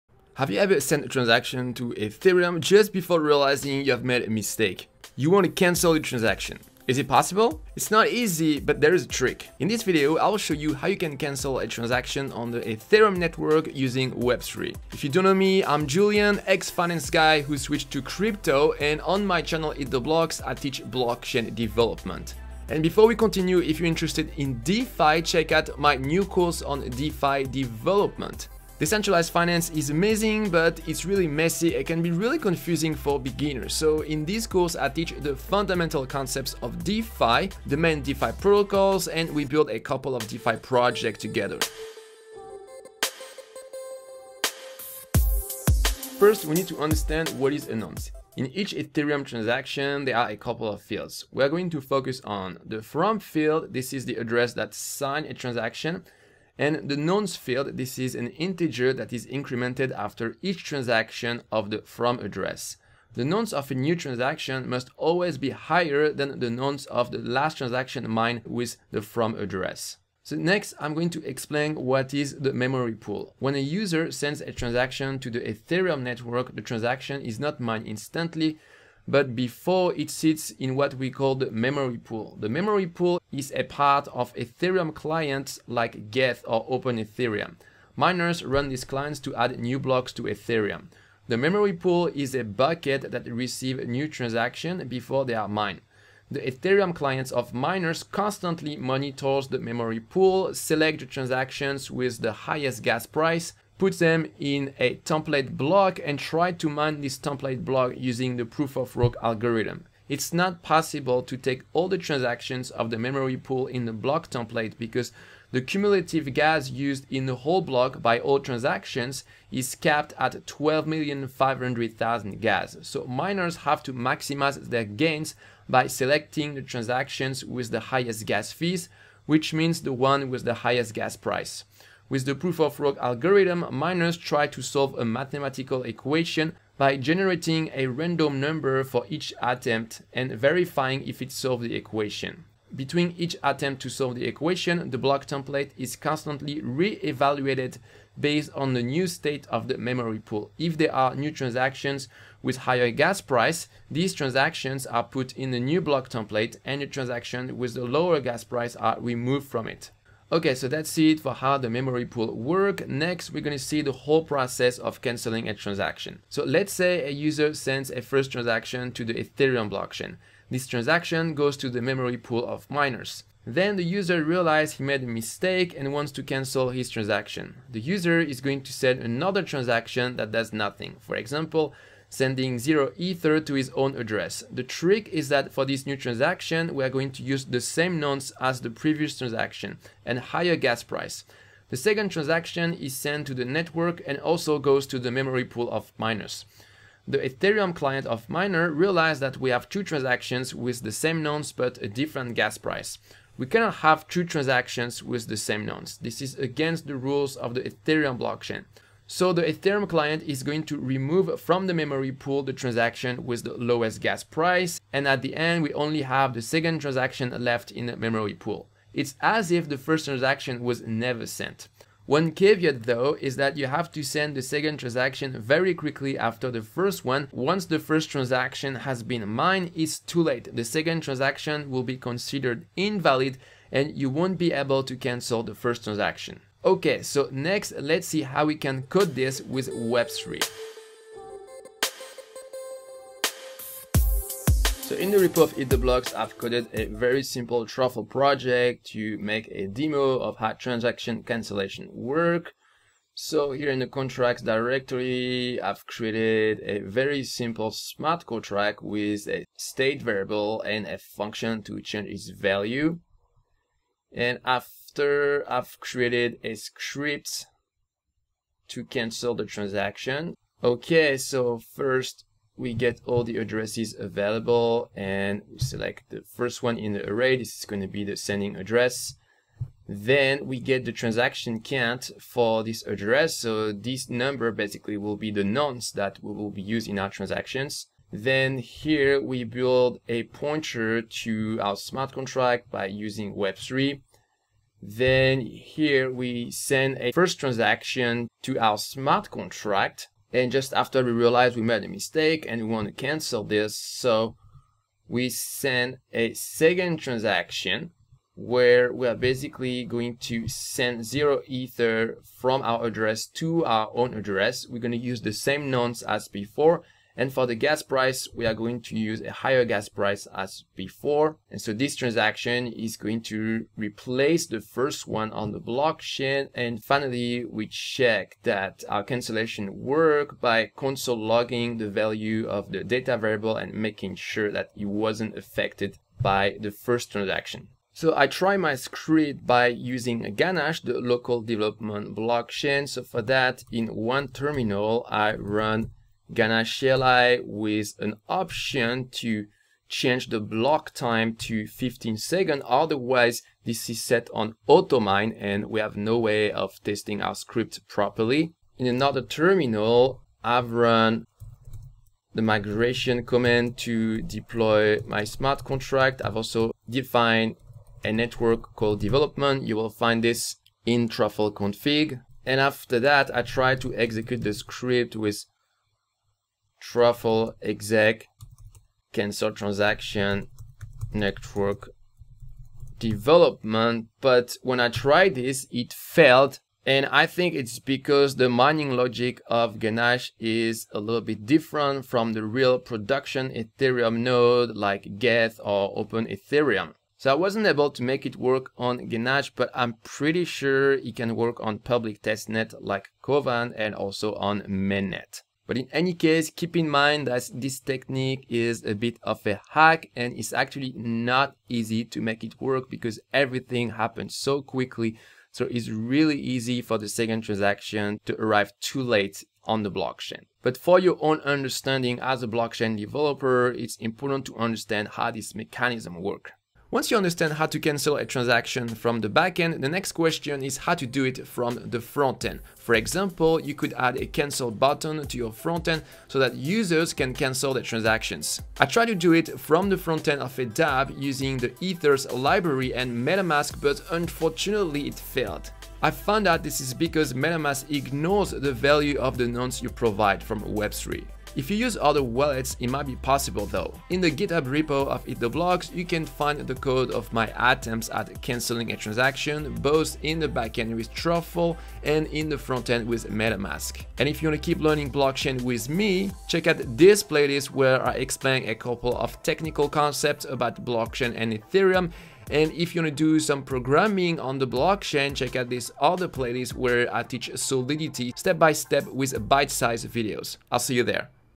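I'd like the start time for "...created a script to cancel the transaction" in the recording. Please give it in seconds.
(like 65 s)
265 s.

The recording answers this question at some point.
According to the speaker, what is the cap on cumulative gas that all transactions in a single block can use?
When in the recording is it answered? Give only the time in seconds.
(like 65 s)
120 s.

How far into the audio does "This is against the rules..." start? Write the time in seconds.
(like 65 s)
205 s.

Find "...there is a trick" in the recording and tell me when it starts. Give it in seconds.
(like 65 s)
8 s.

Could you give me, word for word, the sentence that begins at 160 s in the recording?
Okay, so that's it for how the memory pool work.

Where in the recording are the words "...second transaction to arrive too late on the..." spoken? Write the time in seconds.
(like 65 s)
417 s.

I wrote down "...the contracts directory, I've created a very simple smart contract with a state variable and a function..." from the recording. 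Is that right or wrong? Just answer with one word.
right.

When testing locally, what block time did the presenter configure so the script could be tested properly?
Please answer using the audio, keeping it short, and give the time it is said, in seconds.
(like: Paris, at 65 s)
15 seconds, at 351 s.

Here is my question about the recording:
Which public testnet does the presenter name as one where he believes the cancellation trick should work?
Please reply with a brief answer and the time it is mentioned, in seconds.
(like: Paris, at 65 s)
Kovan, at 403 s.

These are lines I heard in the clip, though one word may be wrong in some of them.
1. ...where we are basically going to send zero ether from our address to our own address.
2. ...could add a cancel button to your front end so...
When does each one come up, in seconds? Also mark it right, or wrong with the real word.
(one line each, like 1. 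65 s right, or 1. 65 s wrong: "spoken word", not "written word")
1. 308 s right
2. 433 s right.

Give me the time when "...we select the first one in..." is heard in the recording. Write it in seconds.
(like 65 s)
275 s.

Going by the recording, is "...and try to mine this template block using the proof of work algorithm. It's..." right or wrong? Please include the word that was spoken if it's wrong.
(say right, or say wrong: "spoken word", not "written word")
right.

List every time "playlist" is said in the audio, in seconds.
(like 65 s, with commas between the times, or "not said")
467 s, 476 s.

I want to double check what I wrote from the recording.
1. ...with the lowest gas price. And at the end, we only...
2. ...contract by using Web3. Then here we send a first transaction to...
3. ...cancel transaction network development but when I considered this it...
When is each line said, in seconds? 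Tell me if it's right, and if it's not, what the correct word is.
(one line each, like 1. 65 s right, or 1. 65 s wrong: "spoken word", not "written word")
1. 213 s right
2. 292 s right
3. 379 s wrong: "tried", not "considered".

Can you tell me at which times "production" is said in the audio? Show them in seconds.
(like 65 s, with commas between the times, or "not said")
392 s.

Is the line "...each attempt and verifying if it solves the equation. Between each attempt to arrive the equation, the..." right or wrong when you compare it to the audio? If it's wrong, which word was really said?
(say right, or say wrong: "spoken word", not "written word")
wrong: "solve", not "arrive".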